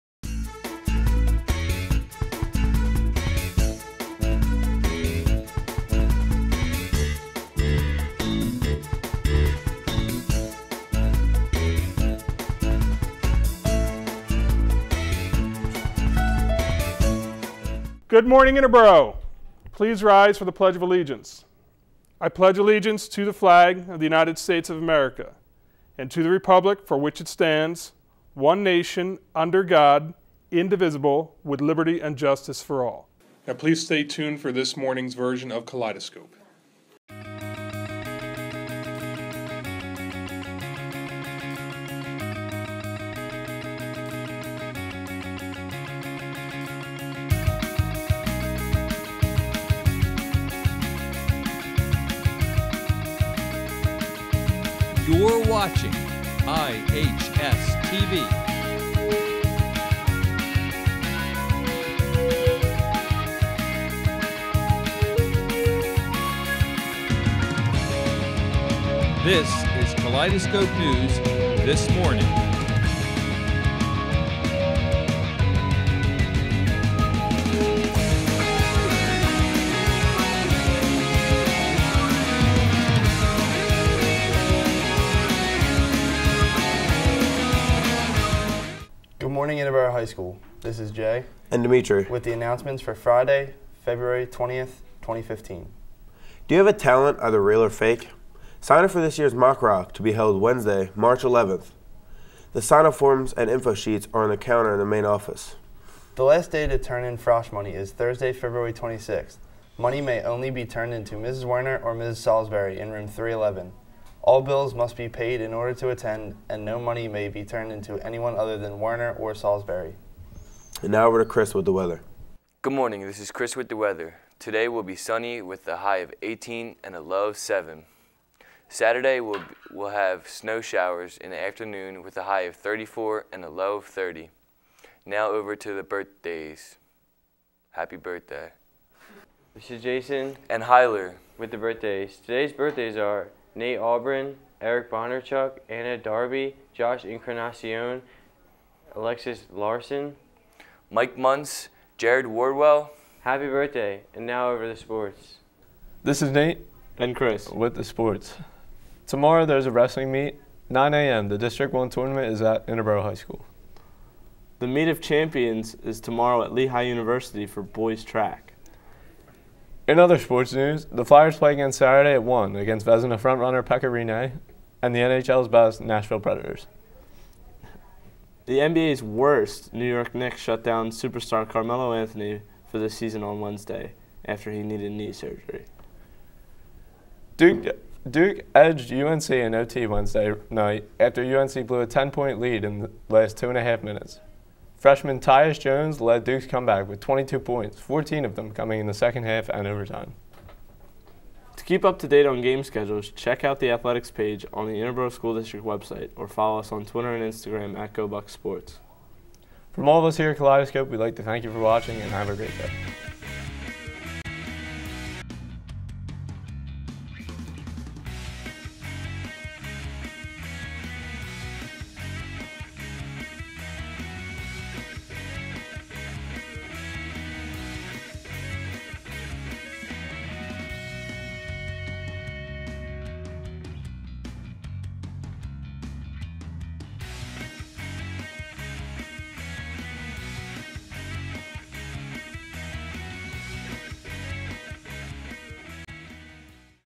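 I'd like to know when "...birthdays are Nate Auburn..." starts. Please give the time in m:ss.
2:22.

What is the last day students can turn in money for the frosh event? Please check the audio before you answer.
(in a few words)
Thursday, February 26th.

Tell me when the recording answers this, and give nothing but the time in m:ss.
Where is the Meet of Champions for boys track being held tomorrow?
2:46.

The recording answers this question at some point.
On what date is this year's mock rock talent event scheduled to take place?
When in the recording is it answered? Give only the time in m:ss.
1:40.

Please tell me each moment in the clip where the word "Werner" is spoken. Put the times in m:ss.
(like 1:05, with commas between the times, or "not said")
1:51, 1:58.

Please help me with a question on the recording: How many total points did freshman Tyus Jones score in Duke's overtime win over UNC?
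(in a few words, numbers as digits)
22.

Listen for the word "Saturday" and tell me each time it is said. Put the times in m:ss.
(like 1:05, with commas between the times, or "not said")
2:08, 2:51.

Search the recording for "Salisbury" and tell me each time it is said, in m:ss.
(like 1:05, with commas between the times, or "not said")
1:52, 1:59.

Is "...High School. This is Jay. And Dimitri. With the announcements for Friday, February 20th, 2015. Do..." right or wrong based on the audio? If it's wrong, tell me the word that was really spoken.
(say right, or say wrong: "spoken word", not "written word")
right.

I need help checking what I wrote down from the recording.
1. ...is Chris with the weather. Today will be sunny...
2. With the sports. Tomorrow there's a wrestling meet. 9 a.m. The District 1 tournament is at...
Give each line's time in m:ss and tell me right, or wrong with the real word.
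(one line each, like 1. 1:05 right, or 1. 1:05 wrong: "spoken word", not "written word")
1. 2:03 right
2. 2:37 right.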